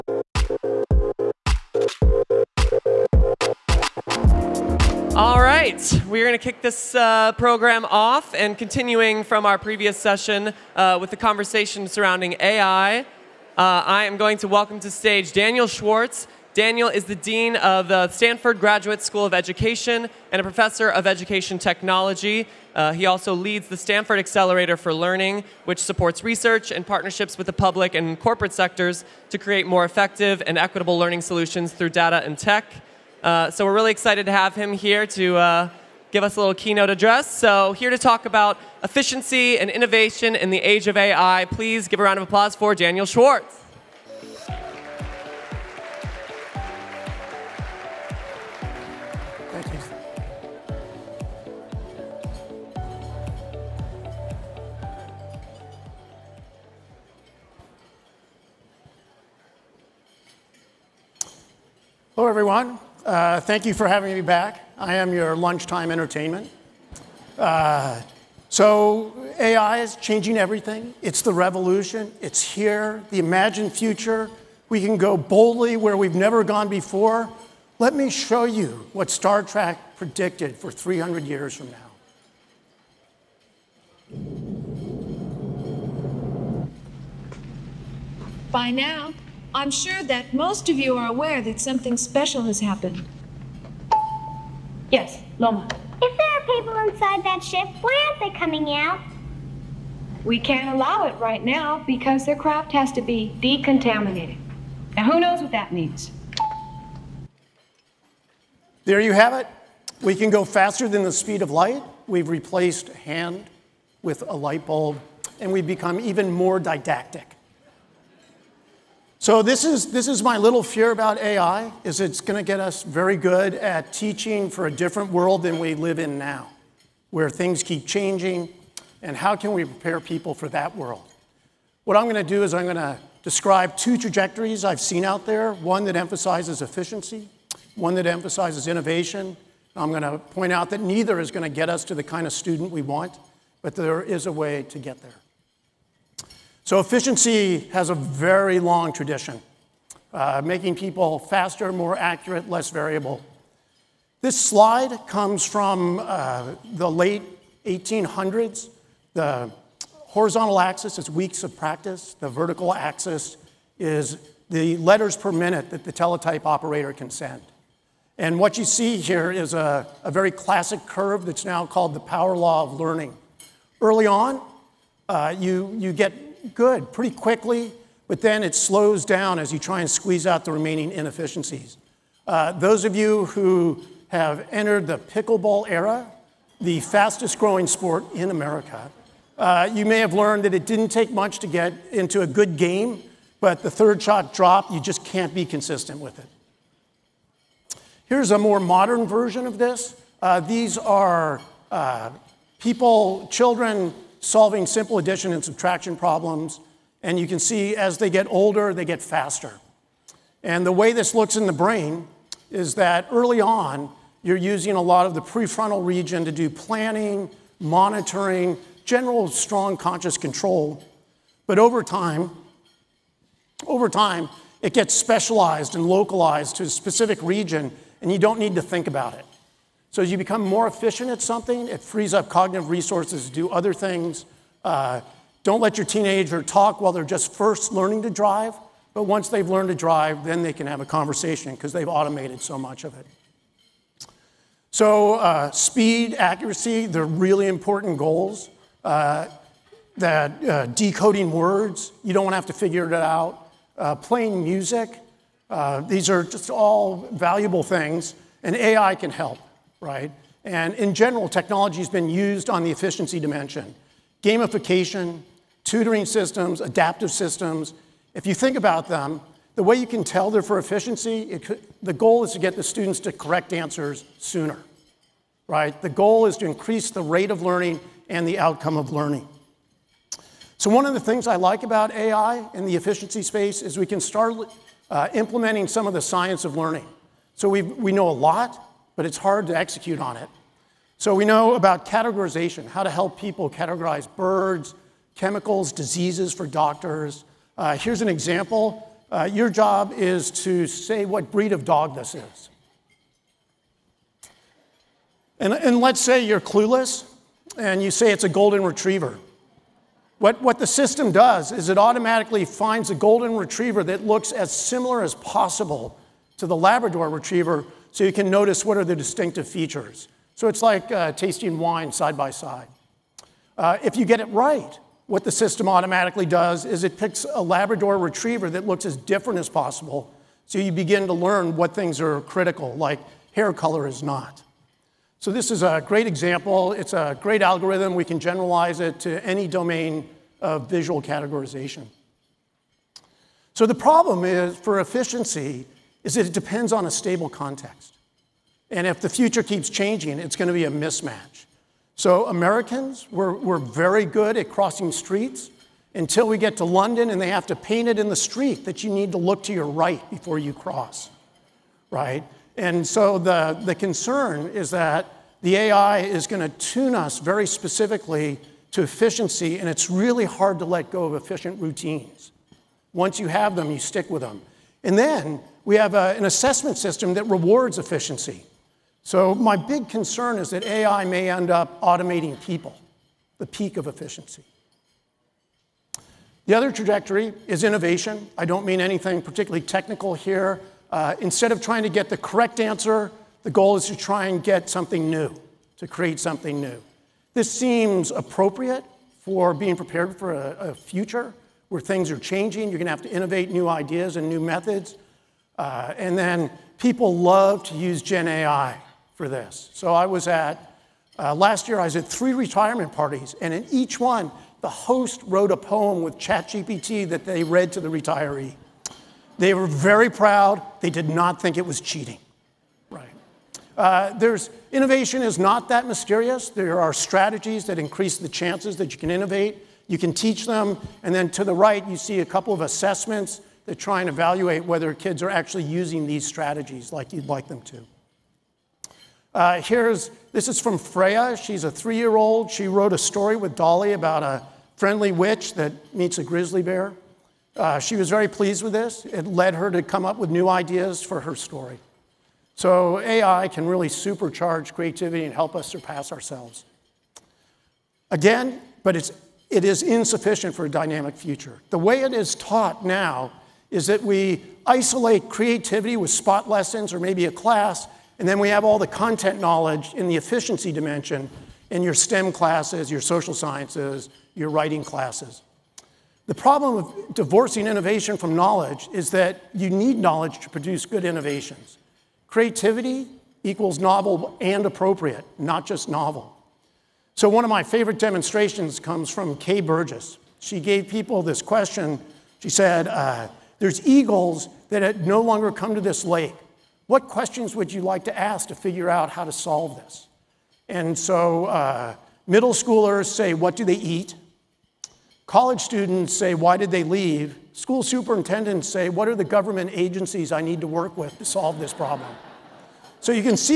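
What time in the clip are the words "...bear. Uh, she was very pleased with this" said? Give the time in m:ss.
7:26.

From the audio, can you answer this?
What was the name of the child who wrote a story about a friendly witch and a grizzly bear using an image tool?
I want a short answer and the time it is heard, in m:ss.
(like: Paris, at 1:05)
Freya, at 7:20.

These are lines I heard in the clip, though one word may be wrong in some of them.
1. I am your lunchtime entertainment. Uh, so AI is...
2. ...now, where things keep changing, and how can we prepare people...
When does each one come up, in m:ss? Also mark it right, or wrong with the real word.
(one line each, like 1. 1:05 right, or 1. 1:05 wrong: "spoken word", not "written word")
1. 1:04 right
2. 2:06 right.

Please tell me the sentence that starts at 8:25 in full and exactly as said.
College students say, why did they leave?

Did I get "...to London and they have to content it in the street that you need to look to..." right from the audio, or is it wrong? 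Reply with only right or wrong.
wrong.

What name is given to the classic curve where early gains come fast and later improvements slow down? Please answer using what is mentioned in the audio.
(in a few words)
Power law of learning.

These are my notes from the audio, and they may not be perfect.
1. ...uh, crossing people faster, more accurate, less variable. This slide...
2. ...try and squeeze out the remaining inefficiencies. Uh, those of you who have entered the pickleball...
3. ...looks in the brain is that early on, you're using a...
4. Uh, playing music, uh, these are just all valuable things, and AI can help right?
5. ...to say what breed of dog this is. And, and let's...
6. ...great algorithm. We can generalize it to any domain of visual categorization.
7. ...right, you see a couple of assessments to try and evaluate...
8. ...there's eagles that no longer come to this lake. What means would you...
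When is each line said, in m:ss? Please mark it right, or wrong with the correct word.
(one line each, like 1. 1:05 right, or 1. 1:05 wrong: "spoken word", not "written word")
1. 2:30 wrong: "making", not "crossing"
2. 2:59 right
3. 3:31 right
4. 4:13 right
5. 5:00 right
6. 5:37 right
7. 7:11 right
8. 8:13 wrong: "questions", not "means".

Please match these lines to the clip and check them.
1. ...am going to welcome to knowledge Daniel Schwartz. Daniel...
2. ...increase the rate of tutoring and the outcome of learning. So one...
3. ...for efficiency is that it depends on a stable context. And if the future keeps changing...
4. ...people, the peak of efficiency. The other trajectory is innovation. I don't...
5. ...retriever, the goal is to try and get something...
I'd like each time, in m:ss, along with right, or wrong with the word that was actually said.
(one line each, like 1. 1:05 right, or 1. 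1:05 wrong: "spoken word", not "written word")
1. 0:14 wrong: "stage", not "knowledge"
2. 4:36 wrong: "learning", not "tutoring"
3. 5:44 right
4. 6:22 right
5. 6:32 wrong: "answer", not "retriever".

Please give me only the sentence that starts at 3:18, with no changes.
Here's a more modern version of this.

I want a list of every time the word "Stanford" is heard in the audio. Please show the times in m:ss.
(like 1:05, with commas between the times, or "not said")
0:18, 0:23.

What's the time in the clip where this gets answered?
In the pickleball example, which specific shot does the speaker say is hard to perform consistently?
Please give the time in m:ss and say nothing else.
3:13.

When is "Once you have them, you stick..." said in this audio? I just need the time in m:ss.
6:12.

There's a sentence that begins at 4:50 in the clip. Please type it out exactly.
So we know about categorization, how to help people categorize birds, chemicals, diseases for doctors.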